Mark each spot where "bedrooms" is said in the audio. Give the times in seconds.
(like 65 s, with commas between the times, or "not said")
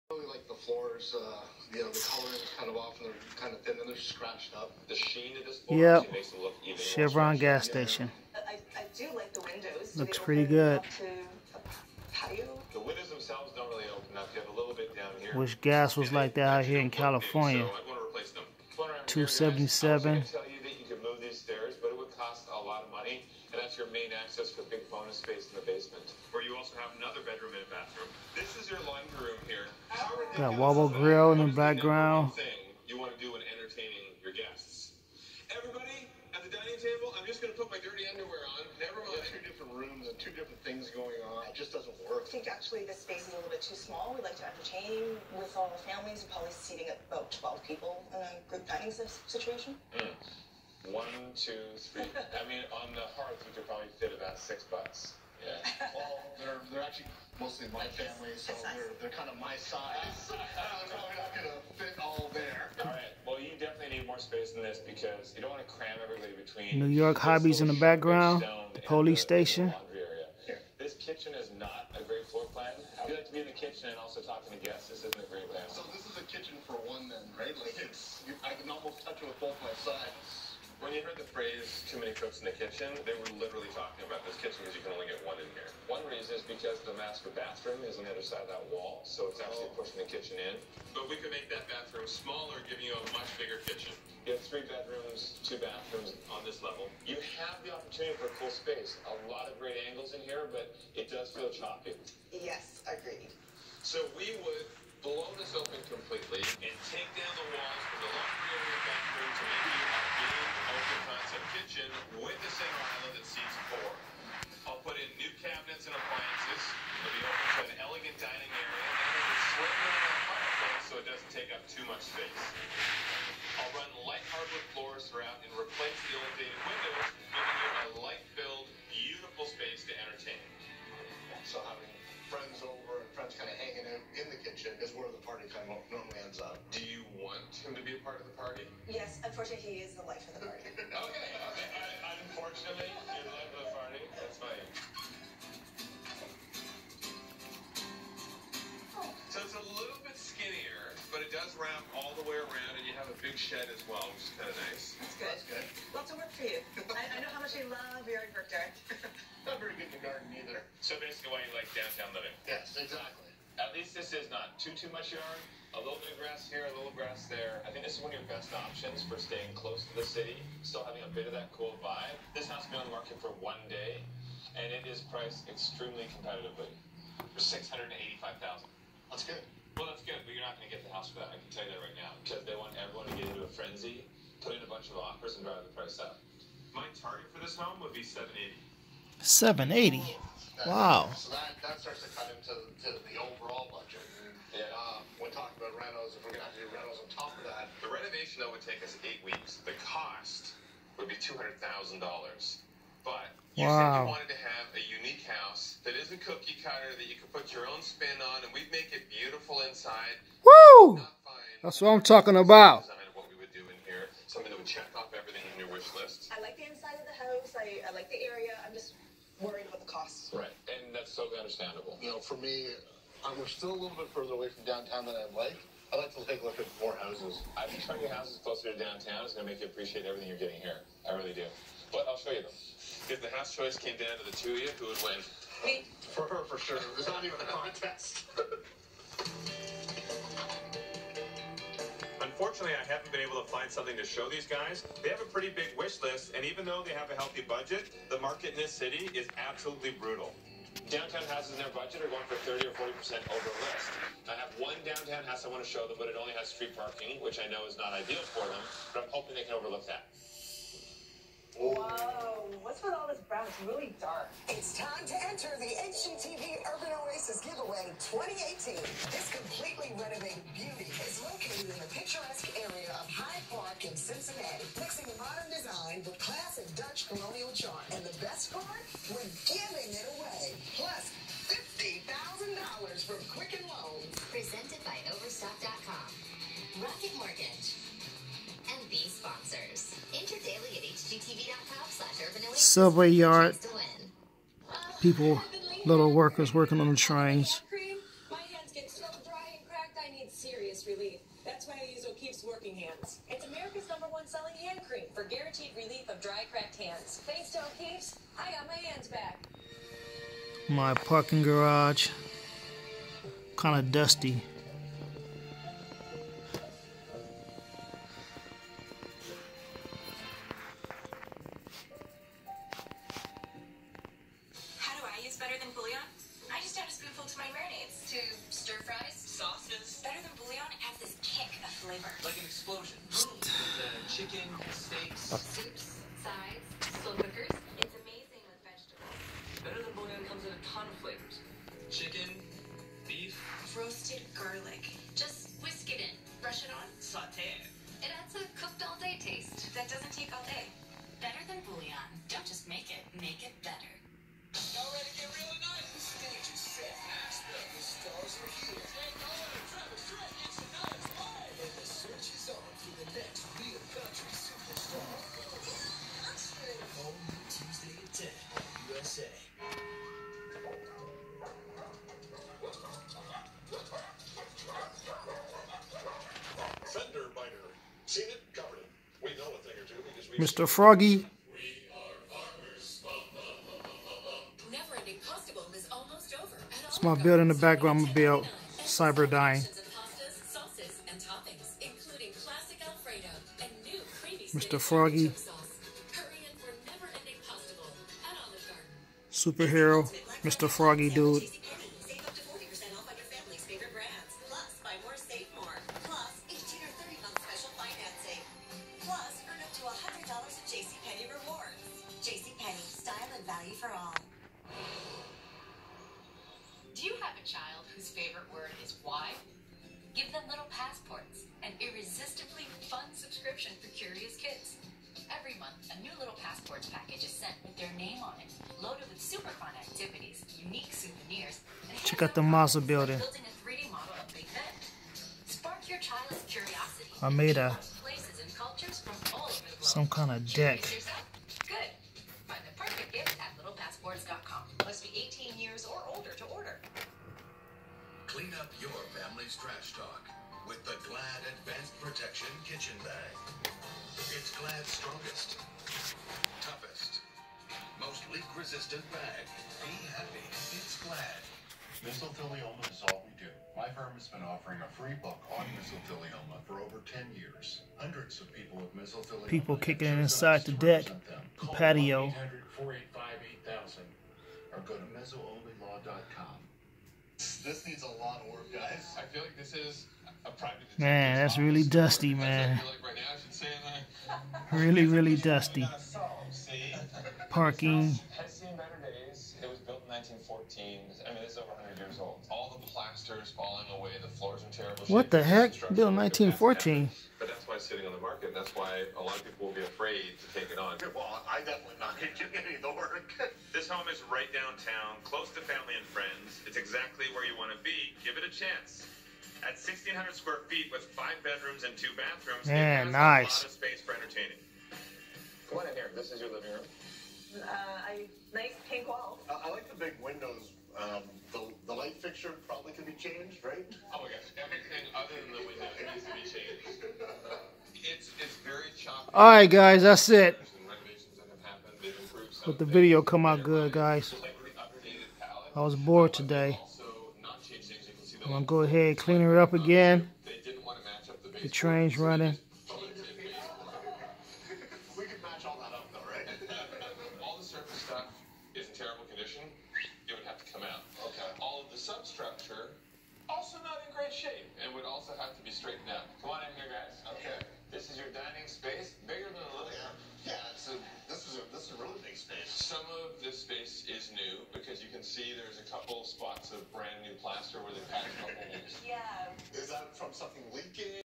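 27 s, 94 s, 511 s.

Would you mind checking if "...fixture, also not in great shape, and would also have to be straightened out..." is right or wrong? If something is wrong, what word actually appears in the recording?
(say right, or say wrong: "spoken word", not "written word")
wrong: "substructure", not "fixture".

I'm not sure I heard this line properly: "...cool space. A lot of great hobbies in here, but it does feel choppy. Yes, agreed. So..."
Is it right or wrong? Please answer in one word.
wrong.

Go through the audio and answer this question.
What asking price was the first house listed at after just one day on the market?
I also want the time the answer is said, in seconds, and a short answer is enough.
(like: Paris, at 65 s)
$685,000, at 177 s.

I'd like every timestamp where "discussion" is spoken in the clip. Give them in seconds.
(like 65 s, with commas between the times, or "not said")
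not said.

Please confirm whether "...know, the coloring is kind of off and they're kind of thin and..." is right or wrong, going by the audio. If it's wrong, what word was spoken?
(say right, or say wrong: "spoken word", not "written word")
right.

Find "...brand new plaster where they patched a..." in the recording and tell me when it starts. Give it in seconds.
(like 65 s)
566 s.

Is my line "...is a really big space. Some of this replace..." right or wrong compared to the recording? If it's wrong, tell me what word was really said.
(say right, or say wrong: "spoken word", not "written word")
wrong: "space", not "replace".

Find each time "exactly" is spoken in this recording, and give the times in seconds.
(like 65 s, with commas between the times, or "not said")
162 s, 506 s.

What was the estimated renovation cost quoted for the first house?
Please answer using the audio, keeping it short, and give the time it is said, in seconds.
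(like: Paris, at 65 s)
$200,000, at 201 s.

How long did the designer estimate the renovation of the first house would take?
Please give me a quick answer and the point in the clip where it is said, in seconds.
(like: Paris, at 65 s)
8 weeks, at 199 s.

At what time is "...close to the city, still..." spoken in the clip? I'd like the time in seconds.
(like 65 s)
169 s.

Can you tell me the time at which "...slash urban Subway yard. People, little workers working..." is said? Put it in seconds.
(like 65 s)
291 s.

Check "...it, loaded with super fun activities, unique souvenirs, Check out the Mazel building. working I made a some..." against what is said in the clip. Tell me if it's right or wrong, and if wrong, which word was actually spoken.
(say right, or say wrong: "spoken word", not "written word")
wrong: "building", not "working".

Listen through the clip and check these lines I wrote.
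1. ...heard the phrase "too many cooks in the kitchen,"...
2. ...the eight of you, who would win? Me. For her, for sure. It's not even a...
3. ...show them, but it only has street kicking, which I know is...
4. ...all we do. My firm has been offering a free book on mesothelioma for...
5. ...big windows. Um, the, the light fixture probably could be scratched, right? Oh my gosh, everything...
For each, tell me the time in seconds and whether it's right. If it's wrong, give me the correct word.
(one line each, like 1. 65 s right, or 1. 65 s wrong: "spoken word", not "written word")
1. 81 s right
2. 234 s wrong: "two", not "eight"
3. 255 s wrong: "parking", not "kicking"
4. 463 s right
5. 519 s wrong: "changed", not "scratched".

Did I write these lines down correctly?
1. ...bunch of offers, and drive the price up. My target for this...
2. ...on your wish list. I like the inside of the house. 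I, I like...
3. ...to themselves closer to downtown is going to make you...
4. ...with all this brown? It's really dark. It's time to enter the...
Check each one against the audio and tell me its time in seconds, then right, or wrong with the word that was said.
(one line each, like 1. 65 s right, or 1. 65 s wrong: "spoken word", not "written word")
1. 184 s right
2. 215 s right
3. 228 s wrong: "houses", not "themselves"
4. 262 s right.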